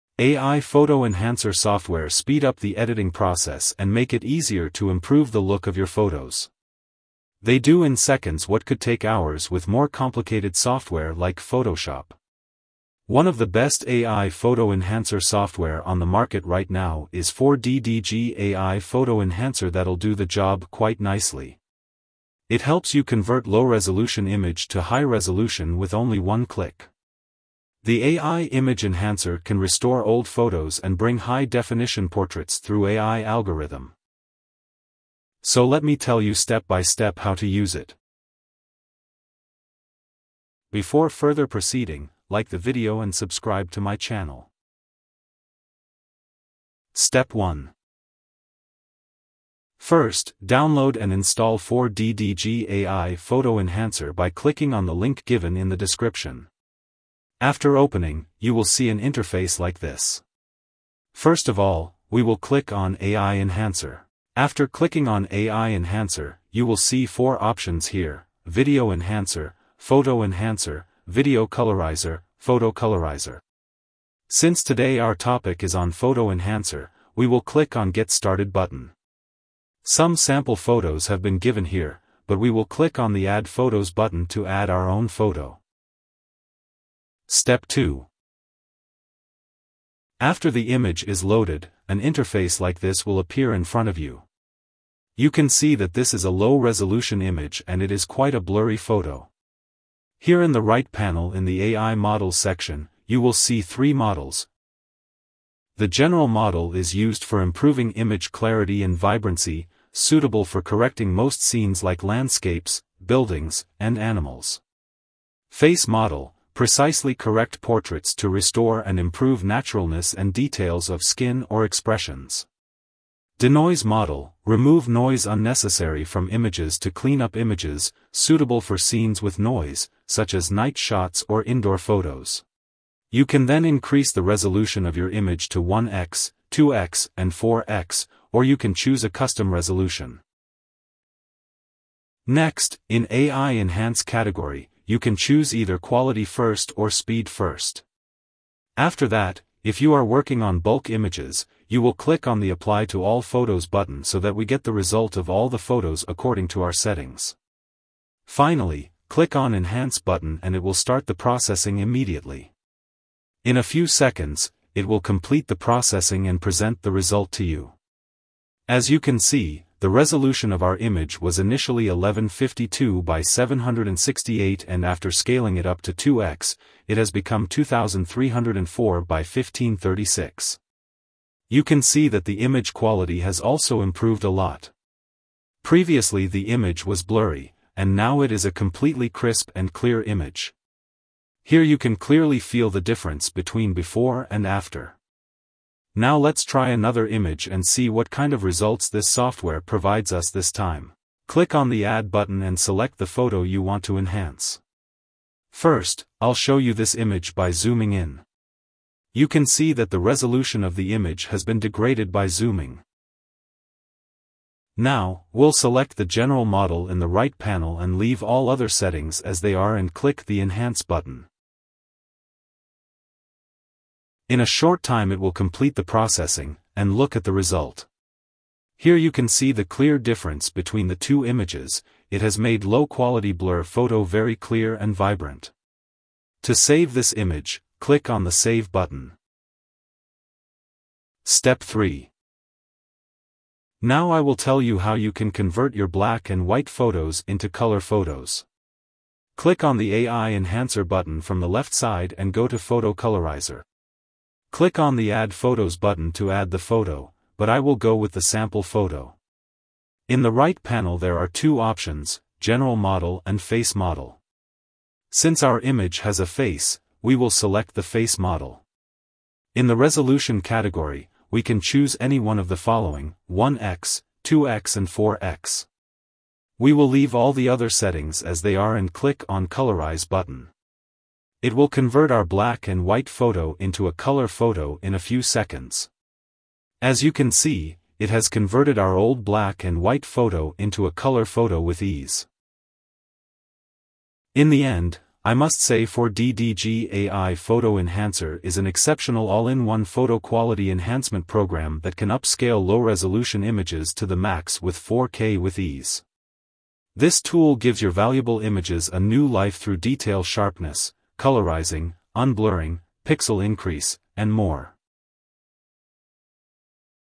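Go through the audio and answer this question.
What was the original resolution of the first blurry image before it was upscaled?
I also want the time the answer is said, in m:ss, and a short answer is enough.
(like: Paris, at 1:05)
1152 by 768, at 2:51.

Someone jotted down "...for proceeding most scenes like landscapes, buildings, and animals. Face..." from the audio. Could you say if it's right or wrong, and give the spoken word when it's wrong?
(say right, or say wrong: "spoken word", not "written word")
wrong: "correcting", not "proceeding".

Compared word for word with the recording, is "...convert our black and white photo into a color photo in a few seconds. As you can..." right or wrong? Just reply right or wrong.
right.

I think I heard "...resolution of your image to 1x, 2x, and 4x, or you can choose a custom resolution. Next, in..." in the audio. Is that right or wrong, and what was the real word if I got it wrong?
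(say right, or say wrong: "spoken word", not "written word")
right.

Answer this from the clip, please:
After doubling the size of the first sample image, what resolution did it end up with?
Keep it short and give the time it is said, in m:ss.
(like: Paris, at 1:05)
2304 by 1536, at 2:57.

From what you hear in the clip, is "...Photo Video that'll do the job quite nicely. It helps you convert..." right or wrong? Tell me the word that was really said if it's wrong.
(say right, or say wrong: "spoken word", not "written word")
wrong: "Enhancer", not "Video".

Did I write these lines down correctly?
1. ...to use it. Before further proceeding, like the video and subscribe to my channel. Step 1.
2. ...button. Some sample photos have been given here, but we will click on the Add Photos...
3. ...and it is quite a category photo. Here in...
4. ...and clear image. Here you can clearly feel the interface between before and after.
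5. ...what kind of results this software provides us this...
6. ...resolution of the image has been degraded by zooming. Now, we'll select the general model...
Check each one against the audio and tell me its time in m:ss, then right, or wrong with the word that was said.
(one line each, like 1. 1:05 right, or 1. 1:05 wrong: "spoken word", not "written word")
1. 0:37 right
2. 1:18 right
3. 1:37 wrong: "blurry", not "category"
4. 3:09 wrong: "difference", not "interface"
5. 3:17 right
6. 3:29 right.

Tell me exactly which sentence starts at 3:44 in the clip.
In a short time it will complete the processing, and look at the result.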